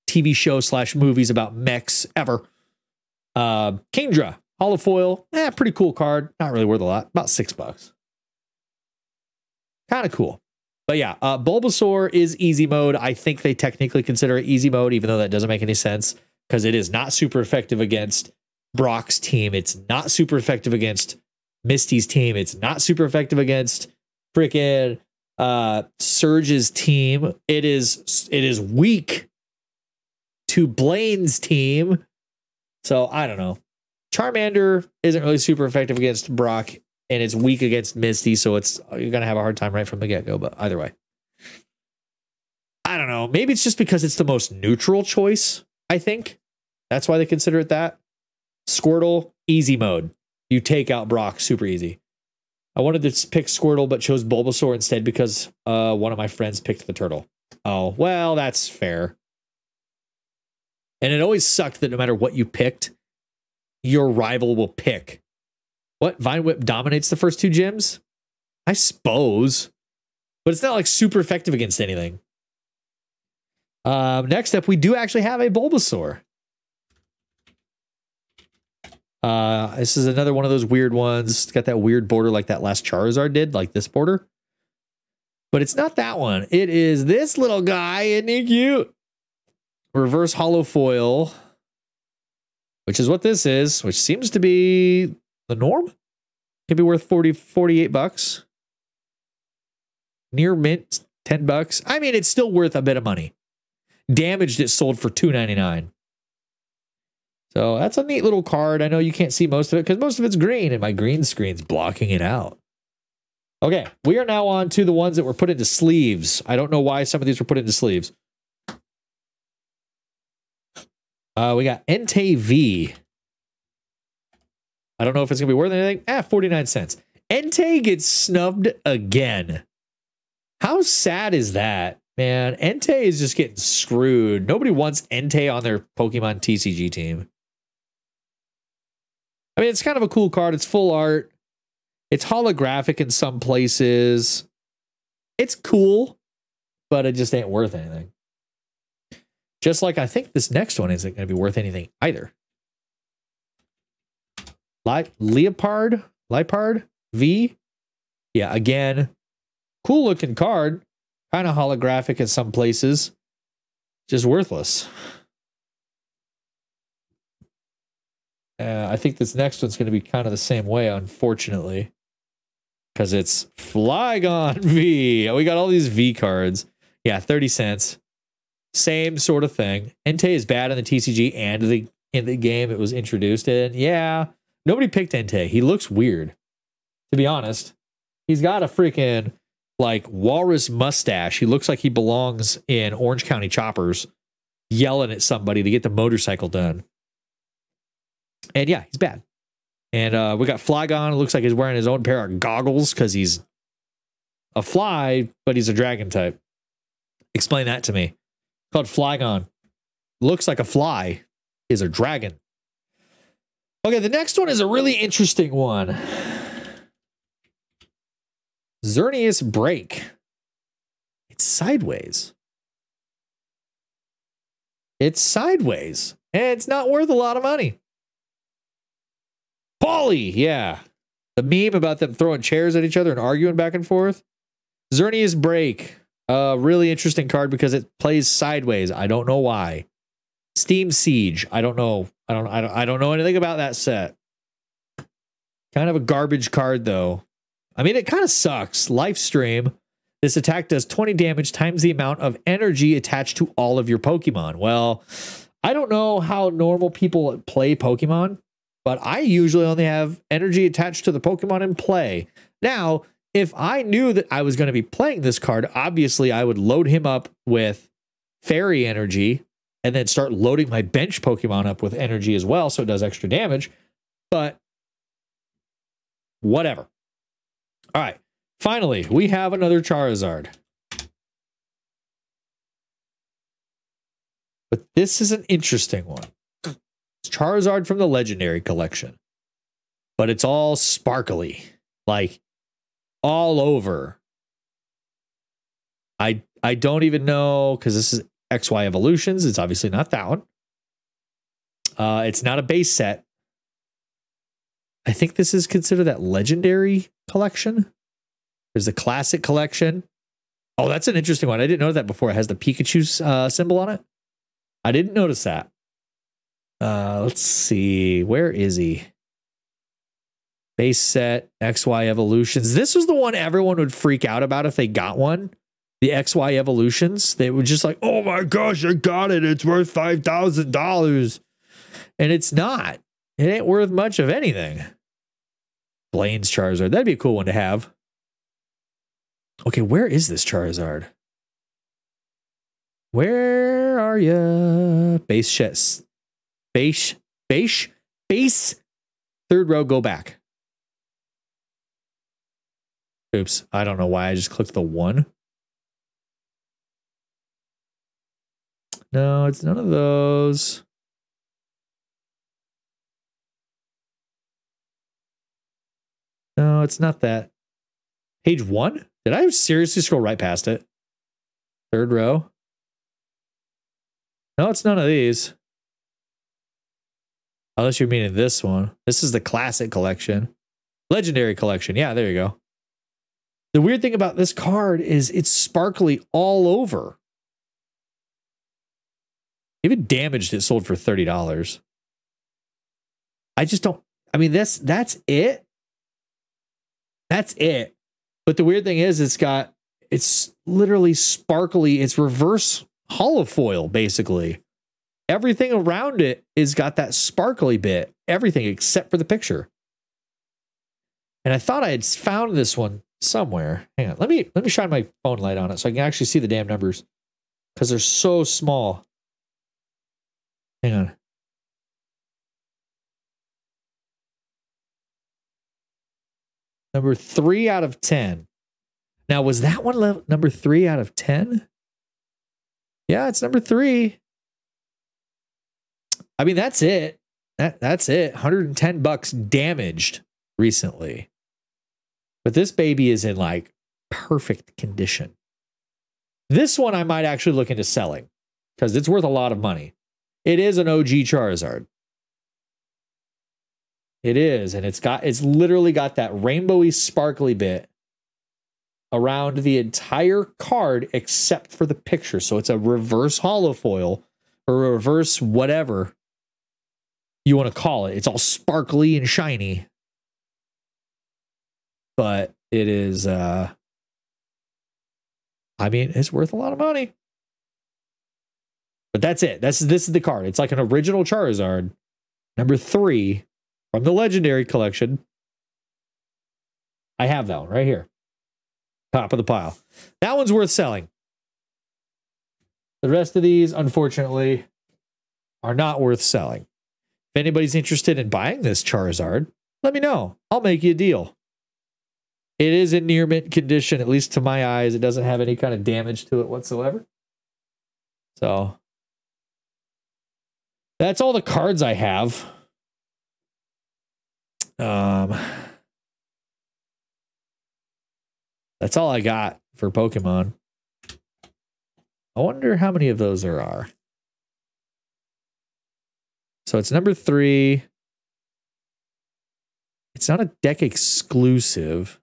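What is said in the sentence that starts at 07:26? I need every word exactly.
This one I might actually look into selling because it's worth a lot of money.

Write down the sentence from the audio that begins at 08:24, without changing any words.
It doesn't have any kind of damage to it whatsoever.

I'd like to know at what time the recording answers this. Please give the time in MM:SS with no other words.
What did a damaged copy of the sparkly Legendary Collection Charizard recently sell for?
07:18.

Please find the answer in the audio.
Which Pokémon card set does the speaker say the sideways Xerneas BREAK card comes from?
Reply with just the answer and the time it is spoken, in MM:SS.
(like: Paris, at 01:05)
Steam Siege, at 04:00.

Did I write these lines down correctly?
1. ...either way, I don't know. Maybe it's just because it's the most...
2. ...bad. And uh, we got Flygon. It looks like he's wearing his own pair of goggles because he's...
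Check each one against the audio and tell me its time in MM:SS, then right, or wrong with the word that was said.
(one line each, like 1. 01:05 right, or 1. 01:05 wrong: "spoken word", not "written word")
1. 00:40 right
2. 03:18 right.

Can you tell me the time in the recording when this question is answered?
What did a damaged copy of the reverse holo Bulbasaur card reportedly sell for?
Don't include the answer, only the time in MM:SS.
01:45.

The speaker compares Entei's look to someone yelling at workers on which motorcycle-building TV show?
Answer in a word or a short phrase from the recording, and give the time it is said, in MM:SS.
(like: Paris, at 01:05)
Orange County Choppers, at 03:12.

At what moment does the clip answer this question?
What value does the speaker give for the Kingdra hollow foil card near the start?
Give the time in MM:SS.
00:07.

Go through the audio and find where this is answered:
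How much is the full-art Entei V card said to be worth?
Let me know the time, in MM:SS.
02:06.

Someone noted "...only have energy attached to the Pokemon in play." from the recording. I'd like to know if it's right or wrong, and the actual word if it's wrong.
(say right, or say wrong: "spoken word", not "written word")
right.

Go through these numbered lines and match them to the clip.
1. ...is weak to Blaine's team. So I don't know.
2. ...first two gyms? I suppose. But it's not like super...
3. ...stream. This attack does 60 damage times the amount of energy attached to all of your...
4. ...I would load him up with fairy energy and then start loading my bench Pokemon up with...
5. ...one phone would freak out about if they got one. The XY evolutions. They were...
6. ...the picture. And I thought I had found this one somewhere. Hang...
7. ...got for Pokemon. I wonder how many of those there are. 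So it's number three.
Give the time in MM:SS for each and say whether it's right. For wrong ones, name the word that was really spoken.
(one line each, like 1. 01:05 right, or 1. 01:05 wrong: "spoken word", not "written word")
1. 00:28 right
2. 01:07 right
3. 04:09 wrong: "20", not "60"
4. 04:26 right
5. 05:23 wrong: "everyone", not "phone"
6. 06:49 right
7. 08:39 right.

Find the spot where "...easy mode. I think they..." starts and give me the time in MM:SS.
00:12.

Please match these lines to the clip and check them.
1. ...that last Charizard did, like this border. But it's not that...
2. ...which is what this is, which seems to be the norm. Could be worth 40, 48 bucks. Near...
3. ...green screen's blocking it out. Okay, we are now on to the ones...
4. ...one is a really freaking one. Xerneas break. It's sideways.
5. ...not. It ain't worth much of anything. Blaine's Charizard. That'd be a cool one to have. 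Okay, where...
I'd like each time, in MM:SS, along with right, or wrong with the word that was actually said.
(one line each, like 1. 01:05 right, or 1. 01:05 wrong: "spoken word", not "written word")
1. 01:22 right
2. 01:32 right
3. 01:50 right
4. 03:34 wrong: "interesting", not "freaking"
5. 05:32 right.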